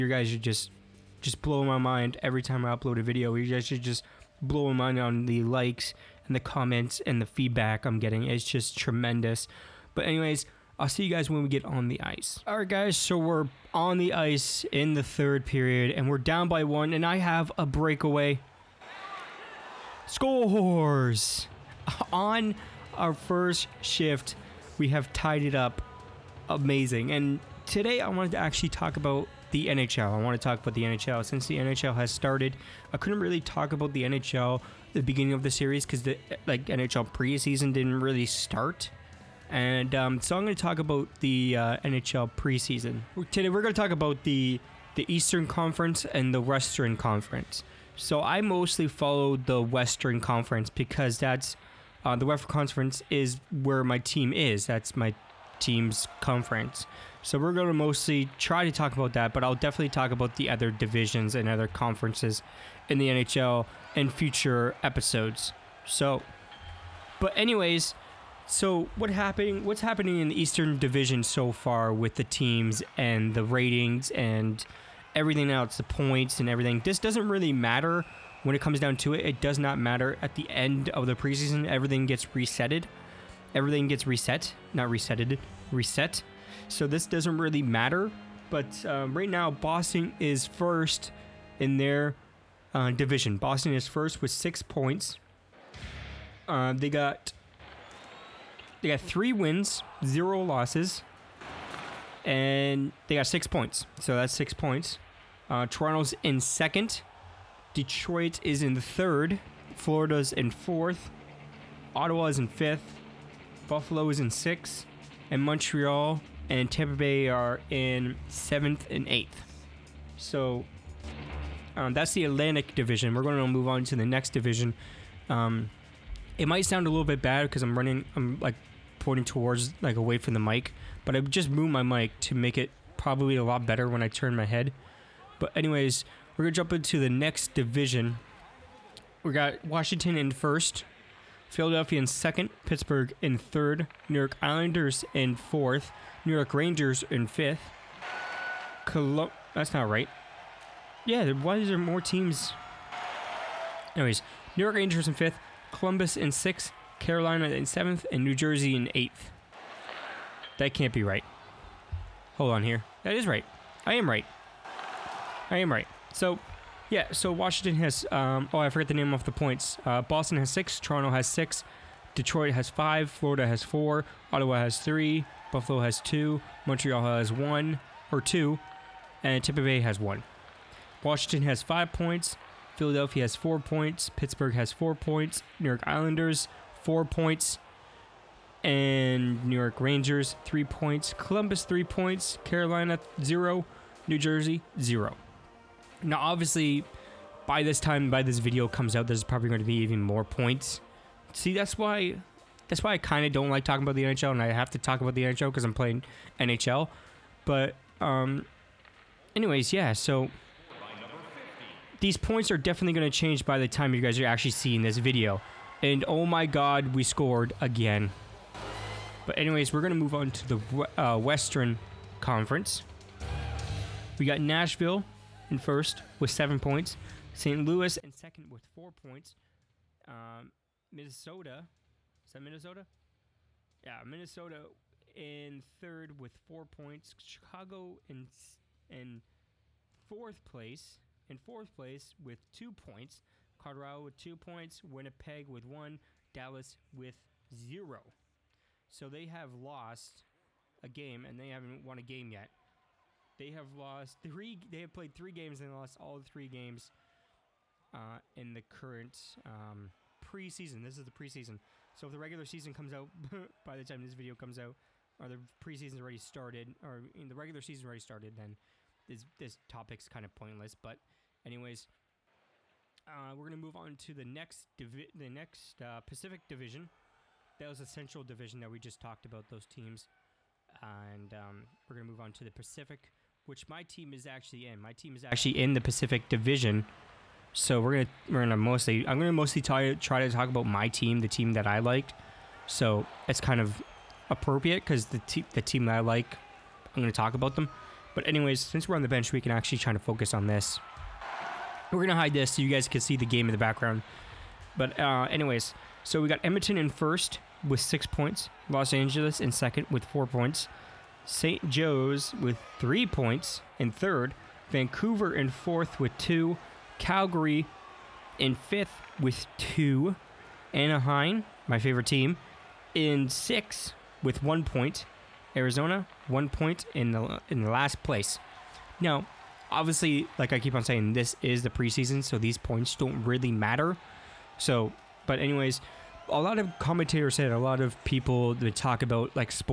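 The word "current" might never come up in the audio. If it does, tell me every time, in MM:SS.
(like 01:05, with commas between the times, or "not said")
04:18.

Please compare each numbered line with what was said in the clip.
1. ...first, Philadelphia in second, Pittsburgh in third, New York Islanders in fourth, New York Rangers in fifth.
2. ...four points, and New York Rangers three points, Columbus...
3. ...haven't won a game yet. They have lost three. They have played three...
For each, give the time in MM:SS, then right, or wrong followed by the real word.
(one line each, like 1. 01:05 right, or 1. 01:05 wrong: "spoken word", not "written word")
1. 02:20 right
2. 03:06 right
3. 04:11 right.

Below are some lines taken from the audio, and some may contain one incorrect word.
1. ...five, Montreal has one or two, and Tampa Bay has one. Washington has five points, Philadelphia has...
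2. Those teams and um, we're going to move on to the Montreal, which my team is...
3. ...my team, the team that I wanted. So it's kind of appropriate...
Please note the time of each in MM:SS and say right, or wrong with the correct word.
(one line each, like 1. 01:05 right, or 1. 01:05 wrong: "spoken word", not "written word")
1. 02:56 wrong: "two", not "five"
2. 04:39 wrong: "Pacific", not "Montreal"
3. 04:50 wrong: "liked", not "wanted".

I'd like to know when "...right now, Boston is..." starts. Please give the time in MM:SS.
01:29.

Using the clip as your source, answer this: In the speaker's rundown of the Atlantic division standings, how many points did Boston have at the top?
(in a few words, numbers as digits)
6.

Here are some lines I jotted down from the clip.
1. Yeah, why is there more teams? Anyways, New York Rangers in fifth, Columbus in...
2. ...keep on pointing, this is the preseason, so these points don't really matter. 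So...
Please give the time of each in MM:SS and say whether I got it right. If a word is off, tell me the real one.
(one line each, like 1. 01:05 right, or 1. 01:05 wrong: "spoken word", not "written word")
1. 02:31 right
2. 05:30 wrong: "saying", not "pointing".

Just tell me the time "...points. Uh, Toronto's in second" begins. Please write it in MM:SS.
01:44.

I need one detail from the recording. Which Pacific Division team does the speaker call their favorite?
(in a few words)
Anaheim.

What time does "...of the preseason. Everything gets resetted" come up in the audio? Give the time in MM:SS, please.
01:20.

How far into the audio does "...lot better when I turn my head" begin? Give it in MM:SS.
02:13.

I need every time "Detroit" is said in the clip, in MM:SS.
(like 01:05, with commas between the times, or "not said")
01:47, 02:52.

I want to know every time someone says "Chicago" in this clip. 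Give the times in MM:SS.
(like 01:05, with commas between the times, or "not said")
03:57.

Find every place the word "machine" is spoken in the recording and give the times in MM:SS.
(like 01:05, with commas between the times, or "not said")
not said.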